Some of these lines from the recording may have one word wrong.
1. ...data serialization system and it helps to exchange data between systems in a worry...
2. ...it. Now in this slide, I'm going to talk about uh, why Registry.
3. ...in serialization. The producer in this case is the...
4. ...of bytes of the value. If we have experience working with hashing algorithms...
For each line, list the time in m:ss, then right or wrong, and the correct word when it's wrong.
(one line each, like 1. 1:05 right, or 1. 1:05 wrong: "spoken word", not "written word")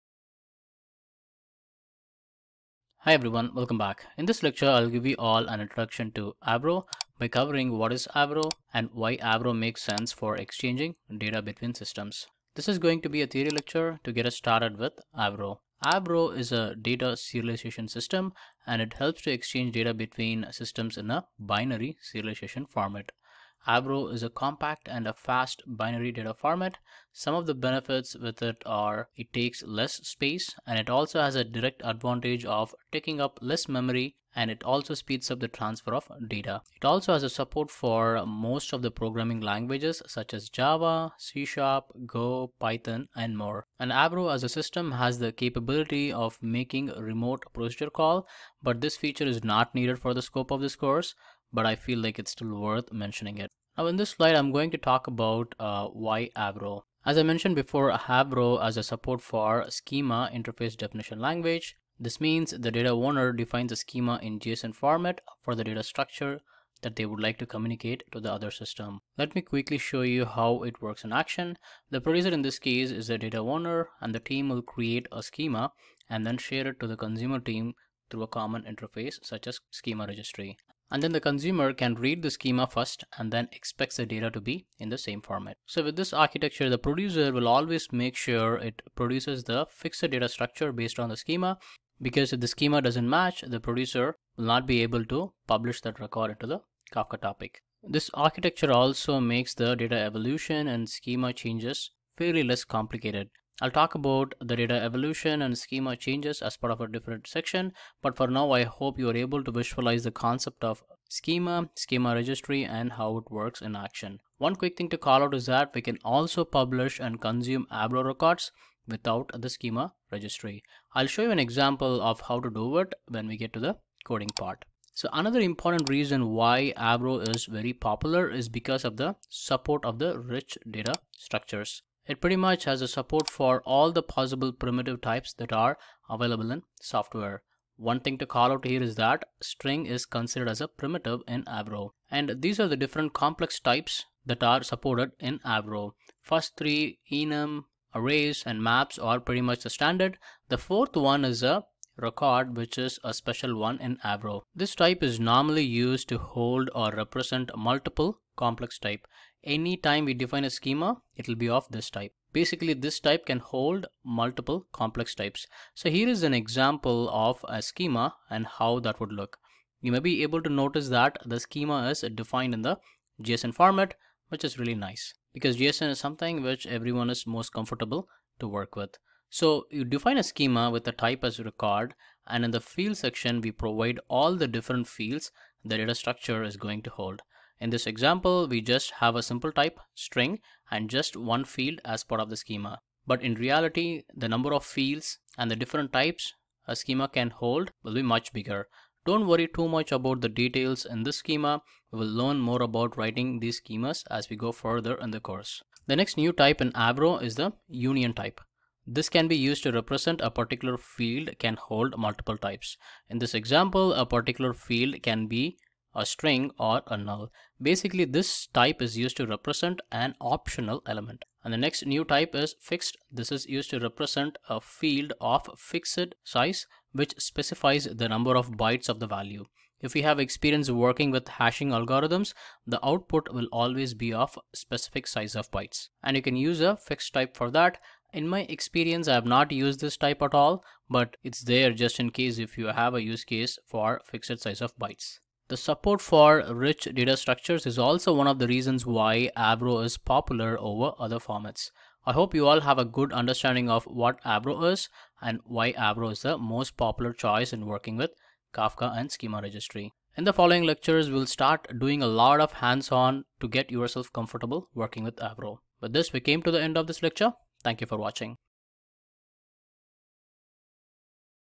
1. 0:16 wrong: "binary", not "worry"
2. 0:53 wrong: "Avro", not "Registry"
3. 1:11 wrong: "action", not "serialization"
4. 3:48 right.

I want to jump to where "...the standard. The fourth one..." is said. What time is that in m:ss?
2:29.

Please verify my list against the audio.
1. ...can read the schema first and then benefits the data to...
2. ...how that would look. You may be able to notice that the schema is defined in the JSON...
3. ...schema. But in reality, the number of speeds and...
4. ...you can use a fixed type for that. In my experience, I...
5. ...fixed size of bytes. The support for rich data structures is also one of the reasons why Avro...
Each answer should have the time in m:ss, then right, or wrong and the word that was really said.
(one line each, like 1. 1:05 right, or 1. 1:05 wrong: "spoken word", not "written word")
1. 1:21 wrong: "expects", not "benefits"
2. 2:48 right
3. 3:12 wrong: "fields", not "speeds"
4. 3:56 right
5. 4:04 right.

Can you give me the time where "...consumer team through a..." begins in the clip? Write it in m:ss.
1:16.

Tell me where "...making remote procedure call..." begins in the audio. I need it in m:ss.
0:46.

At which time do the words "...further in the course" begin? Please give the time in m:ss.
3:24.